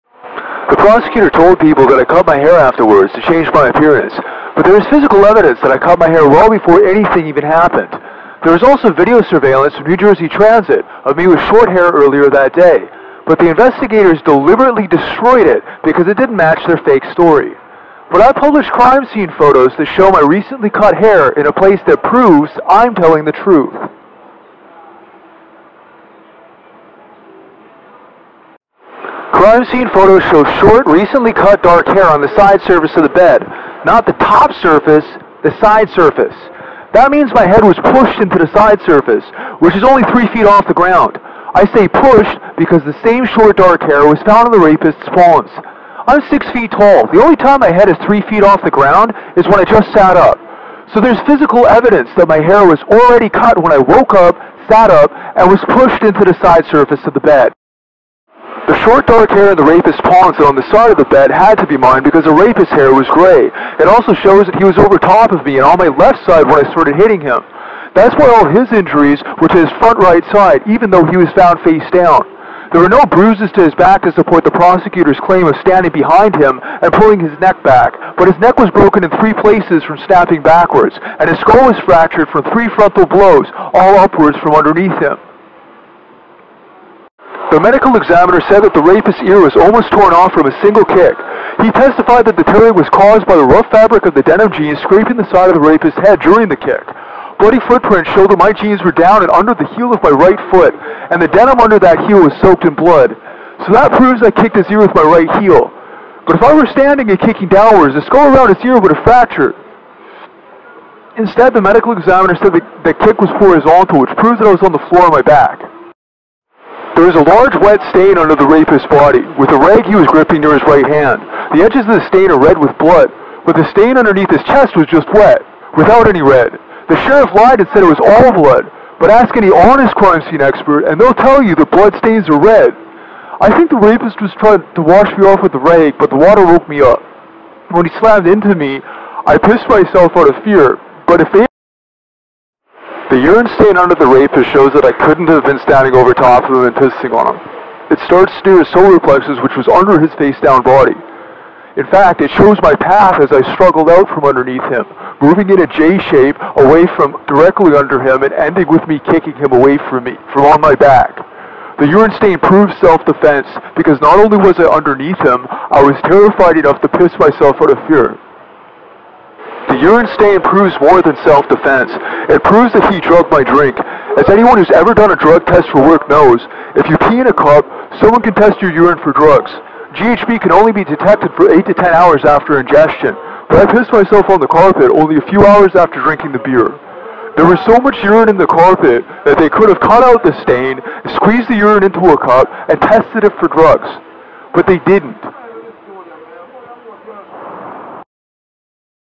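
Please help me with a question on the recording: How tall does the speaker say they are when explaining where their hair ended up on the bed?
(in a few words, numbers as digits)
6 feet.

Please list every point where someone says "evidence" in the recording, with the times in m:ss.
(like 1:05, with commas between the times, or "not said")
0:05, 0:51.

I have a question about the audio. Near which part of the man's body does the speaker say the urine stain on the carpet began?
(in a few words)
Solar plexus.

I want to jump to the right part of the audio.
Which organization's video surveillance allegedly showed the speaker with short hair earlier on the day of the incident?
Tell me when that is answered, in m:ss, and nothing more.
0:09.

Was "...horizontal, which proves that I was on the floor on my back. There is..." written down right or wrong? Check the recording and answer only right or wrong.
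right.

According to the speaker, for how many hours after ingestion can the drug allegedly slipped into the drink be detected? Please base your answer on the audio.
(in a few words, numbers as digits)
8 to 10 hours.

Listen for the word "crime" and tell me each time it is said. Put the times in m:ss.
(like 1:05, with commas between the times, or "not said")
0:18, 0:29, 2:09.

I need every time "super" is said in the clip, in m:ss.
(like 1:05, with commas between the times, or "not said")
not said.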